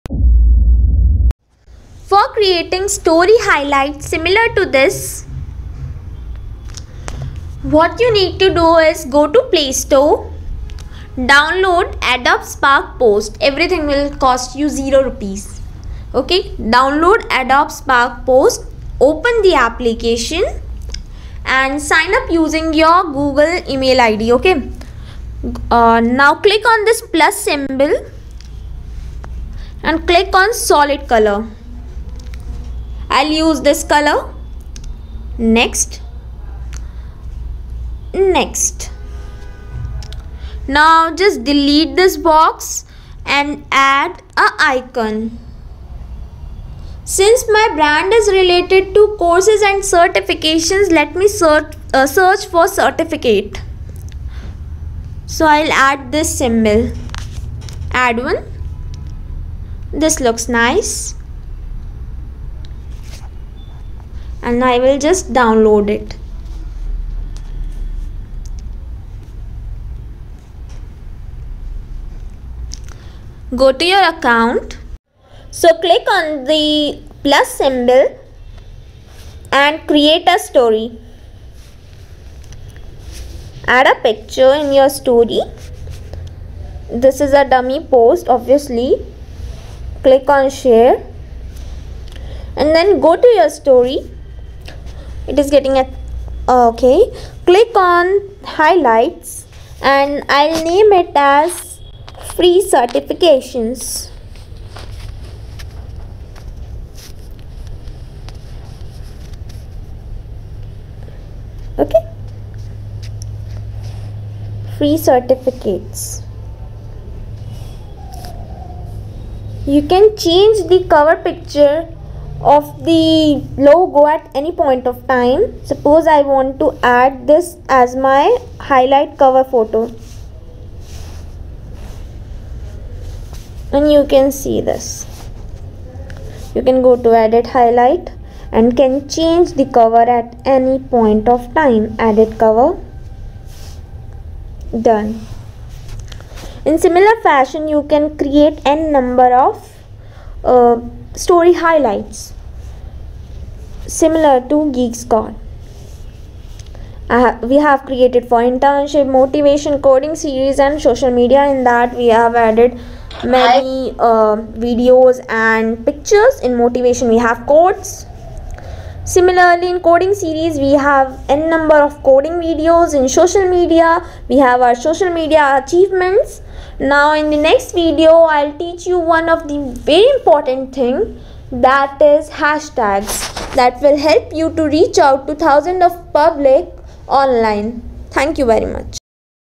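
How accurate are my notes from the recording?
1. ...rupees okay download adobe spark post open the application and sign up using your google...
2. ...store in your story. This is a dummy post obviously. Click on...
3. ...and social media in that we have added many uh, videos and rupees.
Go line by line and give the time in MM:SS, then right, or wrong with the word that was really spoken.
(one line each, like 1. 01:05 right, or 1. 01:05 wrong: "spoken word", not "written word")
1. 00:15 right
2. 01:24 wrong: "picture", not "store"
3. 02:40 wrong: "pictures", not "rupees".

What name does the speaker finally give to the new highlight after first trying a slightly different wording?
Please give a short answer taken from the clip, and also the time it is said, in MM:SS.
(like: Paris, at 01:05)
free certificates, at 01:54.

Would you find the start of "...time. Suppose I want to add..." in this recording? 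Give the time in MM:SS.
02:05.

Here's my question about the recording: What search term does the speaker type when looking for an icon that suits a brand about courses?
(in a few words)
certificate.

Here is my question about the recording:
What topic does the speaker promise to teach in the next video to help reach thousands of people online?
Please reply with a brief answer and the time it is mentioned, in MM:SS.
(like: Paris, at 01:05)
hashtags, at 03:02.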